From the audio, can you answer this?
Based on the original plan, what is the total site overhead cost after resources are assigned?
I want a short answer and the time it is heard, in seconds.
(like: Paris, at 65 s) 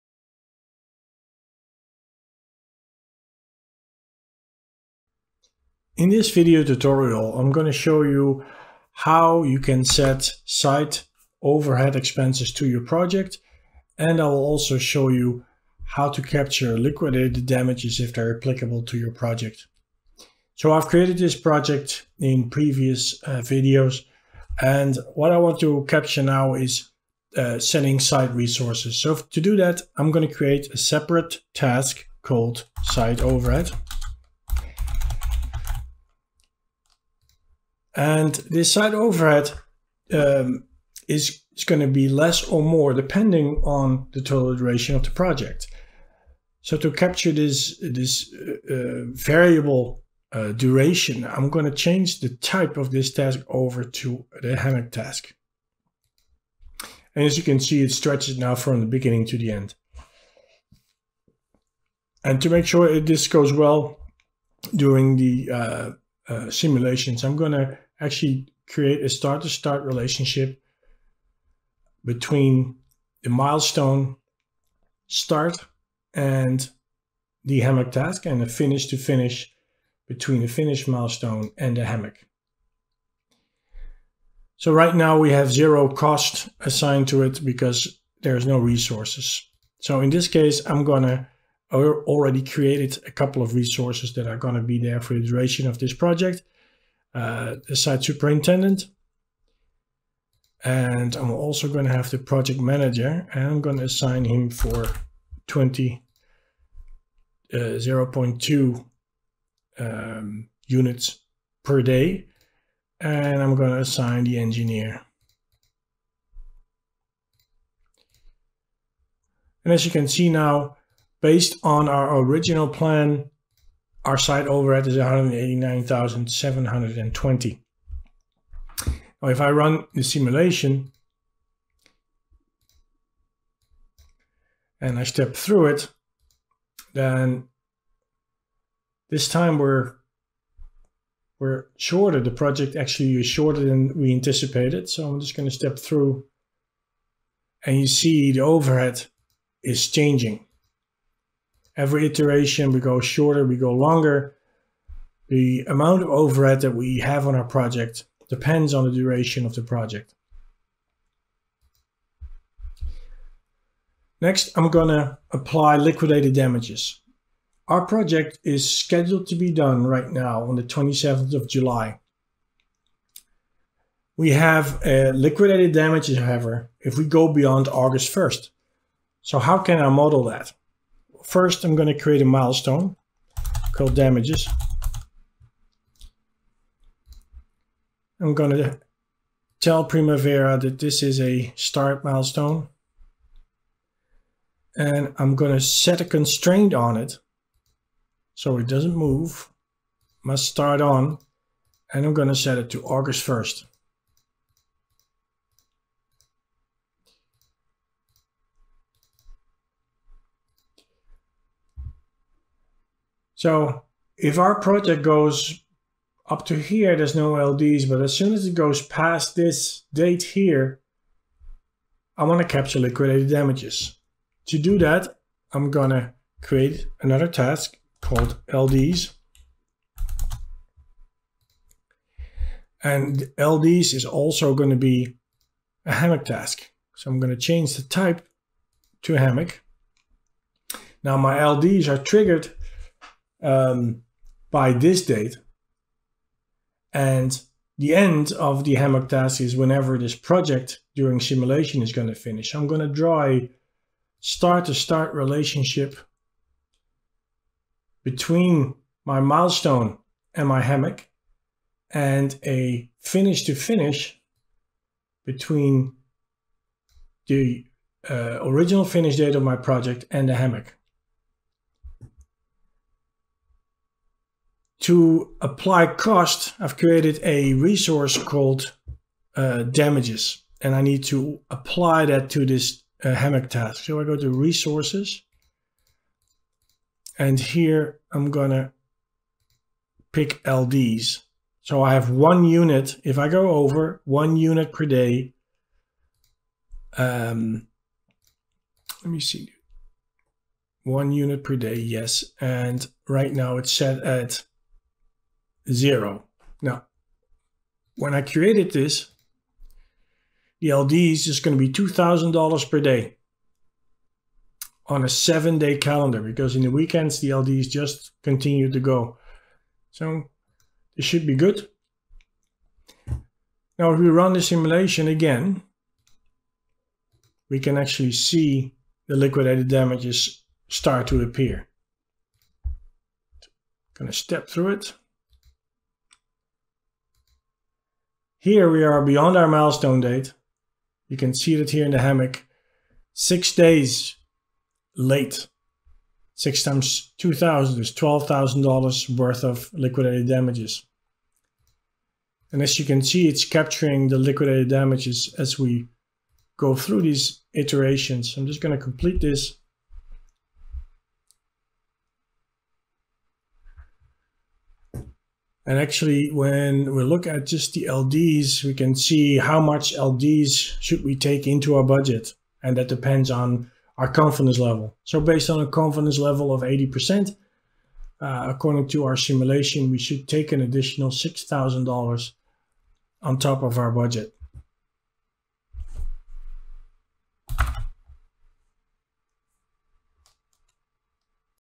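189,720, at 124 s.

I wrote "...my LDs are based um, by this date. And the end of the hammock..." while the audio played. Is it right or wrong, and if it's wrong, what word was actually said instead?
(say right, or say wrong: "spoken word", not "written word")
wrong: "triggered", not "based".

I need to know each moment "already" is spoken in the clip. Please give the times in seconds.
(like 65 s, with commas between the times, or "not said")
91 s.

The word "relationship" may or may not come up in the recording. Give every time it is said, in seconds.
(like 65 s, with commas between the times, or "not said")
69 s, 255 s.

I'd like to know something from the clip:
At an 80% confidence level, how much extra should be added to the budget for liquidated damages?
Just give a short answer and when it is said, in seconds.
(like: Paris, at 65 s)
$6,000, at 381 s.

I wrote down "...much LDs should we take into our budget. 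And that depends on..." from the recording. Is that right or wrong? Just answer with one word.
right.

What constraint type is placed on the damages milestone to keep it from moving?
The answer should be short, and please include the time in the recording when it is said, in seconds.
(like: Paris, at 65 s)
Must start on, at 200 s.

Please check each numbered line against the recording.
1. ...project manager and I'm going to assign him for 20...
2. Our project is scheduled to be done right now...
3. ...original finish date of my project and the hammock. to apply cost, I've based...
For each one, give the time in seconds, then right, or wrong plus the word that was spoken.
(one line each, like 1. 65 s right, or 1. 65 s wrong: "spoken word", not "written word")
1. 102 s right
2. 167 s right
3. 268 s wrong: "created", not "based".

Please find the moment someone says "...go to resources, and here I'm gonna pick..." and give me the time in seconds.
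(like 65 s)
284 s.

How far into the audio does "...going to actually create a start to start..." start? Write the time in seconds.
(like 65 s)
67 s.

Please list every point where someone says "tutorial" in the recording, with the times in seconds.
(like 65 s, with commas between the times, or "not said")
6 s.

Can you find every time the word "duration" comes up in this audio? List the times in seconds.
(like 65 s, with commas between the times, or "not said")
44 s, 50 s, 95 s, 158 s.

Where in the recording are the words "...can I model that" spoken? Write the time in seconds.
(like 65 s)
179 s.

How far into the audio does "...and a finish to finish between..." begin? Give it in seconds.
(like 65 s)
261 s.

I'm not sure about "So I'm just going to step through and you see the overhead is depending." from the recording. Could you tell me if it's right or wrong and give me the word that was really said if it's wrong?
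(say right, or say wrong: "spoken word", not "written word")
wrong: "changing", not "depending".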